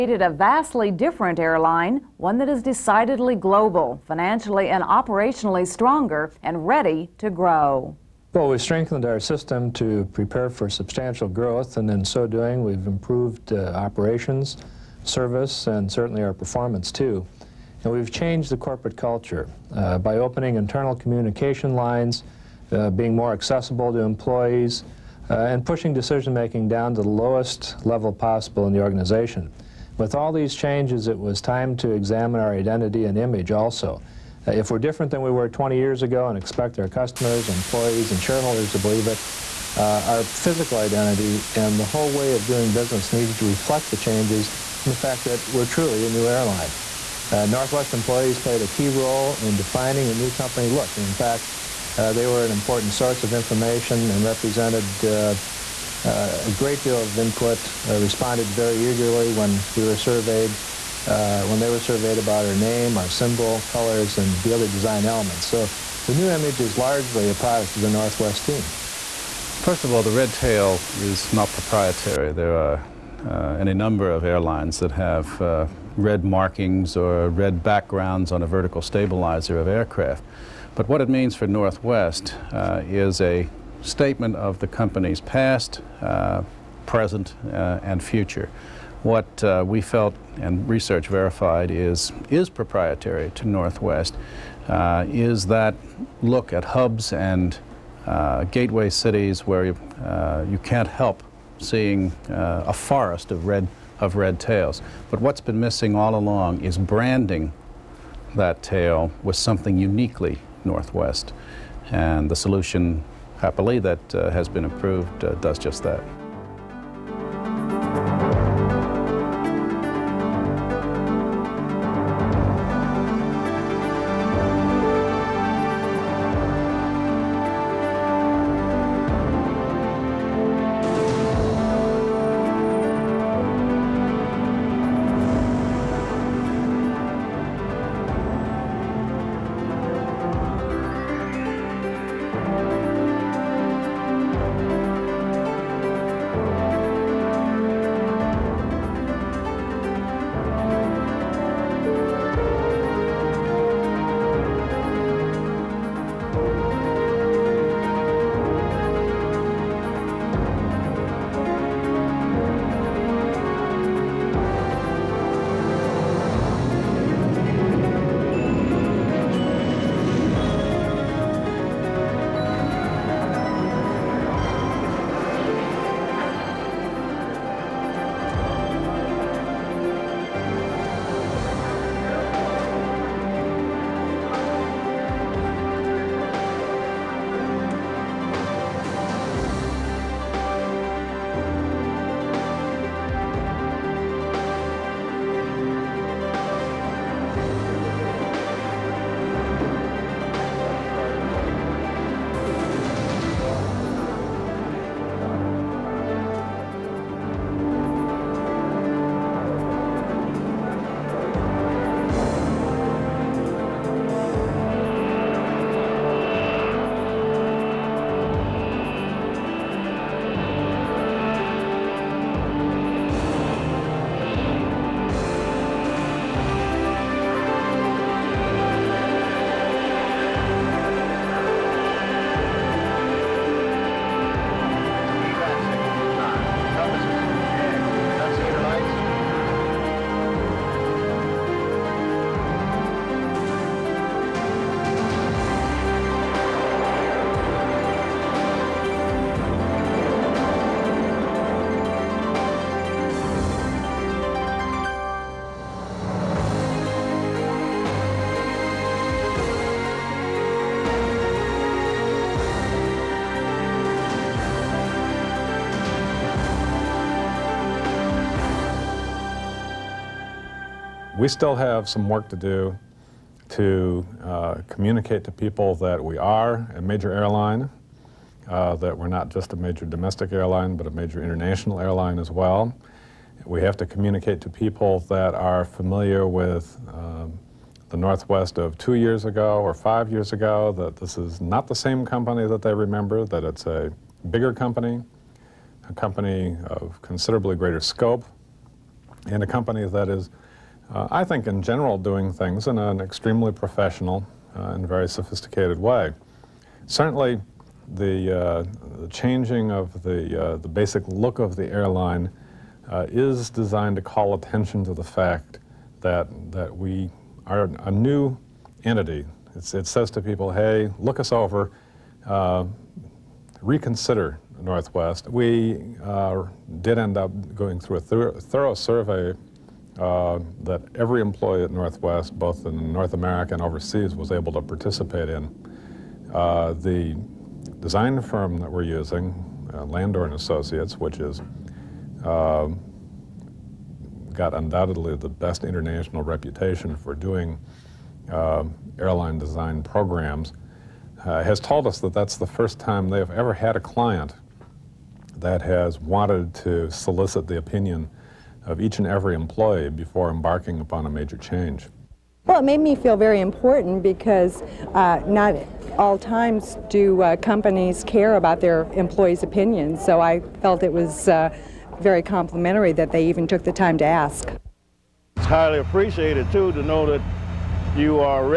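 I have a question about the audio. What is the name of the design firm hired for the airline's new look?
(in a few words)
Landor and Associates.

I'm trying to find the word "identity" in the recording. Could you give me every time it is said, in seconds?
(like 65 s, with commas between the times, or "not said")
32 s, 40 s.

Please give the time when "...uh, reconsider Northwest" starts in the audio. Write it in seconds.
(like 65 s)
322 s.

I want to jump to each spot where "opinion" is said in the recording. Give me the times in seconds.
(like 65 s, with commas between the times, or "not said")
357 s, 369 s.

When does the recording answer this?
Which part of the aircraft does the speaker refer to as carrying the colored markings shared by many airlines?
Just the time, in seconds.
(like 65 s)
78 s.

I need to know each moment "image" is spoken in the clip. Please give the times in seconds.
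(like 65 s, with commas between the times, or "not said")
33 s, 66 s.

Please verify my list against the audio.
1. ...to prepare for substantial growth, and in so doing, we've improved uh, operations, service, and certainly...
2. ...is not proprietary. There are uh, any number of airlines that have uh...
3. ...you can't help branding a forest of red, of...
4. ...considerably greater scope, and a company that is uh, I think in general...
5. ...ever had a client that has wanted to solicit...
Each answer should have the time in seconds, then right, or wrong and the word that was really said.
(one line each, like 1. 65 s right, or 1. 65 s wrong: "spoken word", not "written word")
1. 9 s right
2. 70 s right
3. 100 s wrong: "seeing", not "branding"
4. 297 s right
5. 353 s right.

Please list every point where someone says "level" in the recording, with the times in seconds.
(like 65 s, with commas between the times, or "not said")
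27 s.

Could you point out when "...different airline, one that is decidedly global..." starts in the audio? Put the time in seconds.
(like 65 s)
0 s.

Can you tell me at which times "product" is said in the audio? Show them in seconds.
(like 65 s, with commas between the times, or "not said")
67 s.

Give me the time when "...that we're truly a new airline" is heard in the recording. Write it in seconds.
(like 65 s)
45 s.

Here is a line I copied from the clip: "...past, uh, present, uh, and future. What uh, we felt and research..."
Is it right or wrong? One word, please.
right.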